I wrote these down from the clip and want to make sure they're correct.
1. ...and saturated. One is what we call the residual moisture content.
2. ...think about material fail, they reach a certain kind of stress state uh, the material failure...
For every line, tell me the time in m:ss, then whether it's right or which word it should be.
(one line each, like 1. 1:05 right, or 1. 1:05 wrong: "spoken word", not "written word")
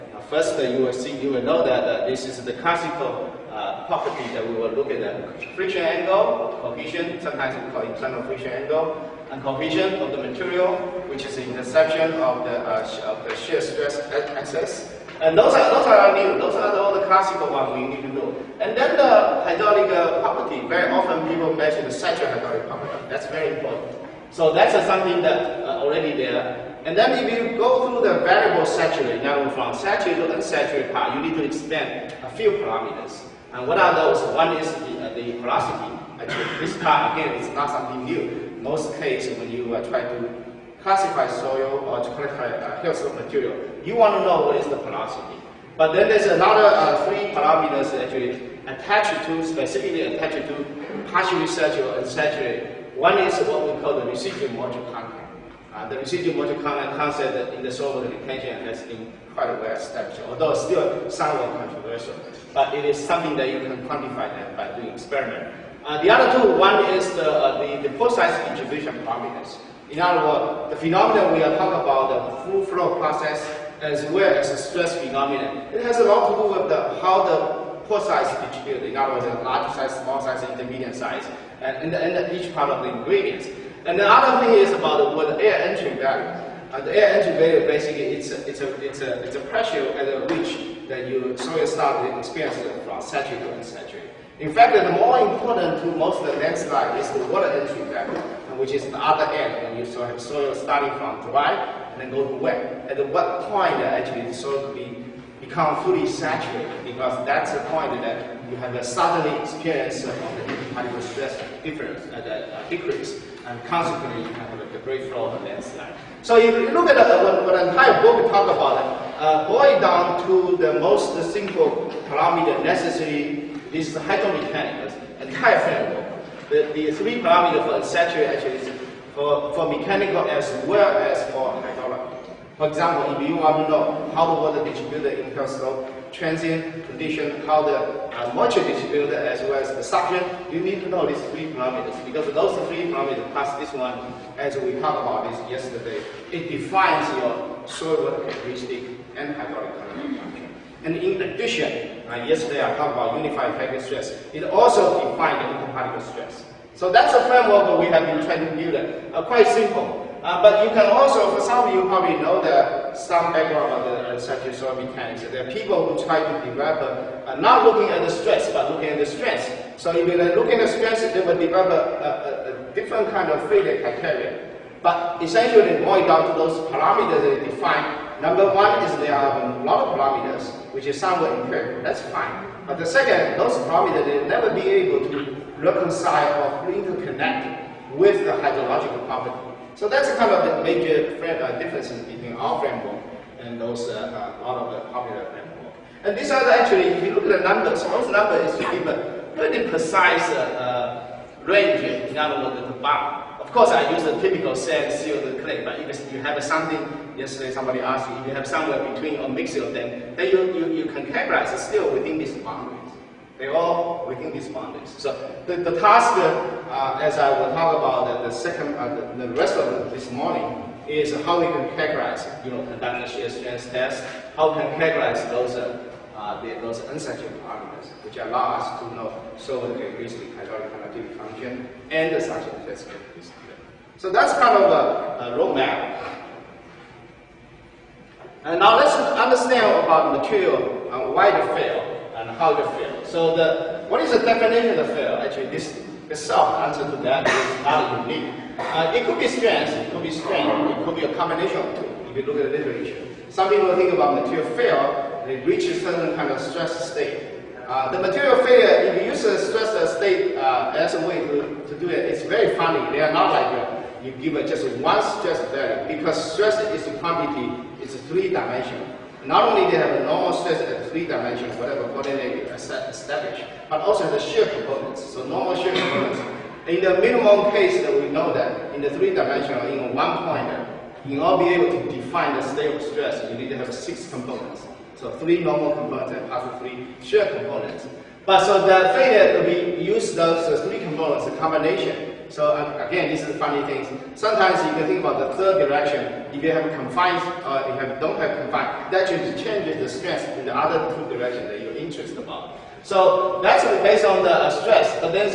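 1. 0:51 right
2. 4:13 right.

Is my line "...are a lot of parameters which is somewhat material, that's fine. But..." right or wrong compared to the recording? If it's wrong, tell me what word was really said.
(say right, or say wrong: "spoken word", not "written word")
wrong: "empirical", not "material".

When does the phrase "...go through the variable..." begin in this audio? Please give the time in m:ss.
0:27.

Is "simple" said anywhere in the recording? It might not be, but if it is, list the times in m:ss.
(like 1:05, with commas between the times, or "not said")
2:01, 2:39.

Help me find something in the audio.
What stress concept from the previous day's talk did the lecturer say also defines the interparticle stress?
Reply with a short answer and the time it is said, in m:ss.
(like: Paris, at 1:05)
unified effective stress, at 2:33.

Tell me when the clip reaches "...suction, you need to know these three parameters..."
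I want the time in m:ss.
2:19.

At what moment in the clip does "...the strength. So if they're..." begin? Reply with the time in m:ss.
2:48.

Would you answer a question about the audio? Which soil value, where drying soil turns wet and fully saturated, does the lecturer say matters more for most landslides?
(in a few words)
water entry value.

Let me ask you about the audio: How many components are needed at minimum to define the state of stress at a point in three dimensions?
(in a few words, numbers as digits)
6.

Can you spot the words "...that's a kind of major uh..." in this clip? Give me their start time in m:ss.
3:09.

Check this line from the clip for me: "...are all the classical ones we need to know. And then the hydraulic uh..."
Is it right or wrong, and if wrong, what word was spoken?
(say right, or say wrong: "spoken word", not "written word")
right.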